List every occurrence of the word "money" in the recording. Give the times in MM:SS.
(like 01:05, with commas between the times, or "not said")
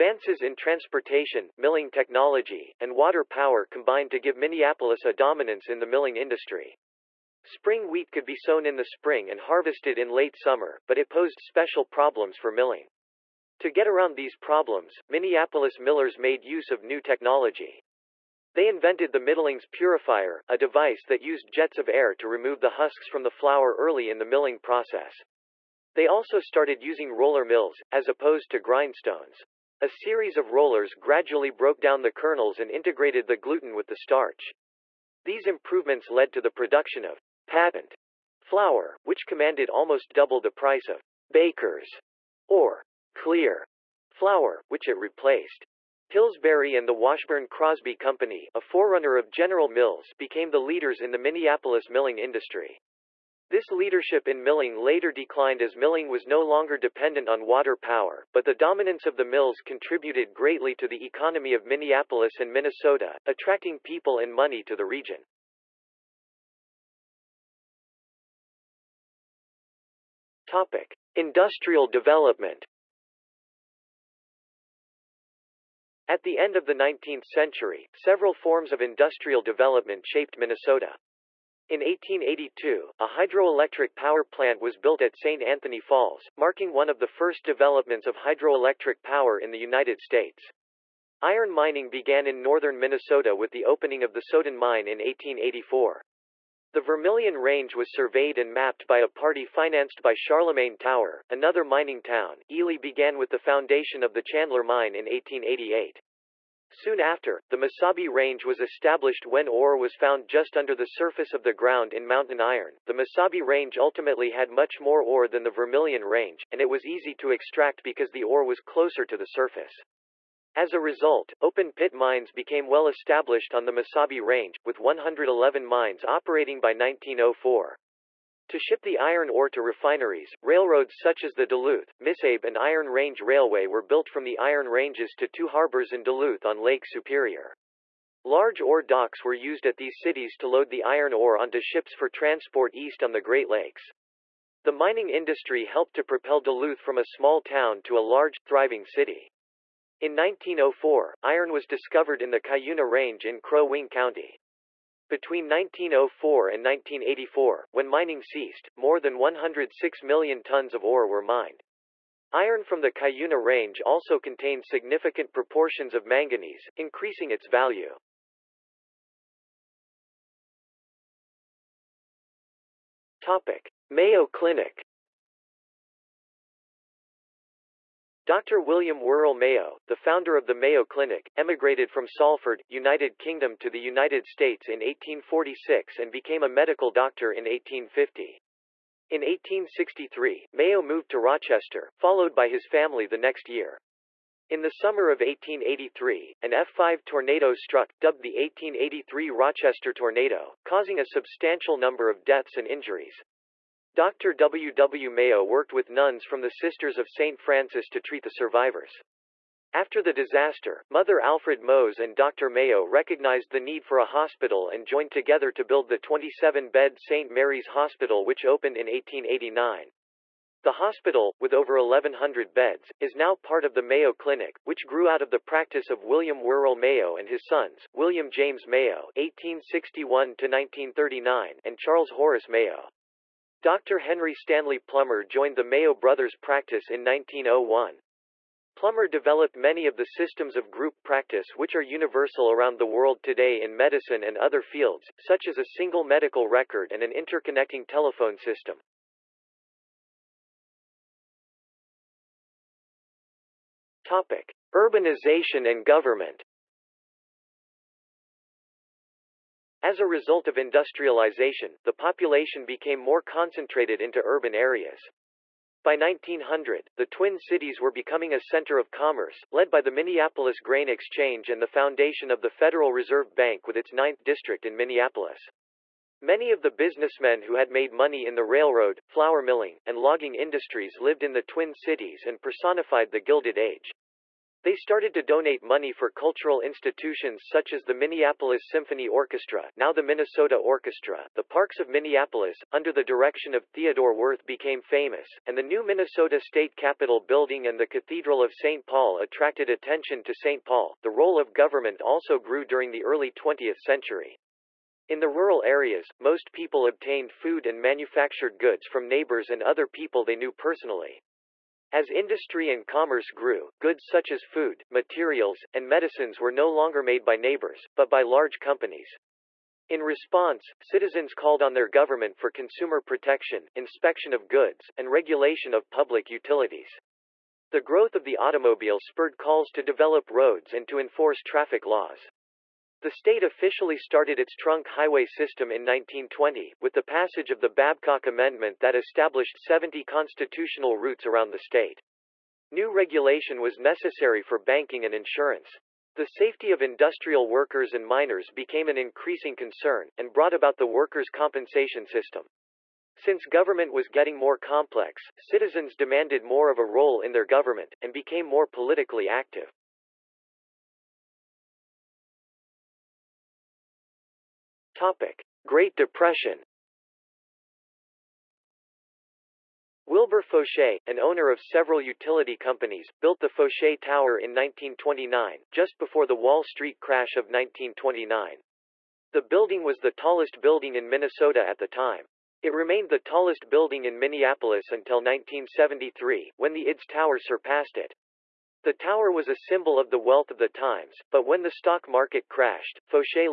01:04, 04:37, 04:45.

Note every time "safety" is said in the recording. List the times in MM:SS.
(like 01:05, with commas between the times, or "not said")
05:46.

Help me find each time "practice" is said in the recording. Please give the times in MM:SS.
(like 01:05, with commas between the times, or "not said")
03:45, 03:56, 04:01.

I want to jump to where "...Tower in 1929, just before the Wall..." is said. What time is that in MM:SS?
06:13.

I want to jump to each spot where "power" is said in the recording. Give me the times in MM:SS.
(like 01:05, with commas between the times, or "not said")
00:03, 00:57, 01:23, 01:29.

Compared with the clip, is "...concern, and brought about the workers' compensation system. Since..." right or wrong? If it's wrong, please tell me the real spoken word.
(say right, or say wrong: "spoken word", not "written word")
right.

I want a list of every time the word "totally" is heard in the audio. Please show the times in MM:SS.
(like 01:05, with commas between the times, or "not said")
not said.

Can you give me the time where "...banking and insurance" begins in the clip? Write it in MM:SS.
05:44.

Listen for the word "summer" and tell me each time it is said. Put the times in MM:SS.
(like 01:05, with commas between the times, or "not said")
00:10, 03:14.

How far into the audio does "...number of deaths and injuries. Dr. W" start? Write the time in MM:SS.
03:21.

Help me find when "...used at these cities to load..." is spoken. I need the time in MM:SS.
02:19.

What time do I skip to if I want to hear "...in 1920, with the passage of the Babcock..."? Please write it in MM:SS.
05:35.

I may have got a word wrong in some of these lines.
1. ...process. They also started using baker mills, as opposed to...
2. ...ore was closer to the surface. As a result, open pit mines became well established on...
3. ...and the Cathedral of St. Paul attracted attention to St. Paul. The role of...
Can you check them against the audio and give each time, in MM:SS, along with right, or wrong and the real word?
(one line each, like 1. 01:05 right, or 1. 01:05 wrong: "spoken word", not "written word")
1. 00:24 wrong: "roller", not "baker"
2. 01:58 right
3. 04:57 right.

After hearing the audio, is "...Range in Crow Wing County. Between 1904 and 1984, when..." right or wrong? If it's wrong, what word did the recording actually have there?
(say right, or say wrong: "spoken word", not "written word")
right.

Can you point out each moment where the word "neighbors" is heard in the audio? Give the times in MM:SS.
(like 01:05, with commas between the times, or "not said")
05:09, 05:17.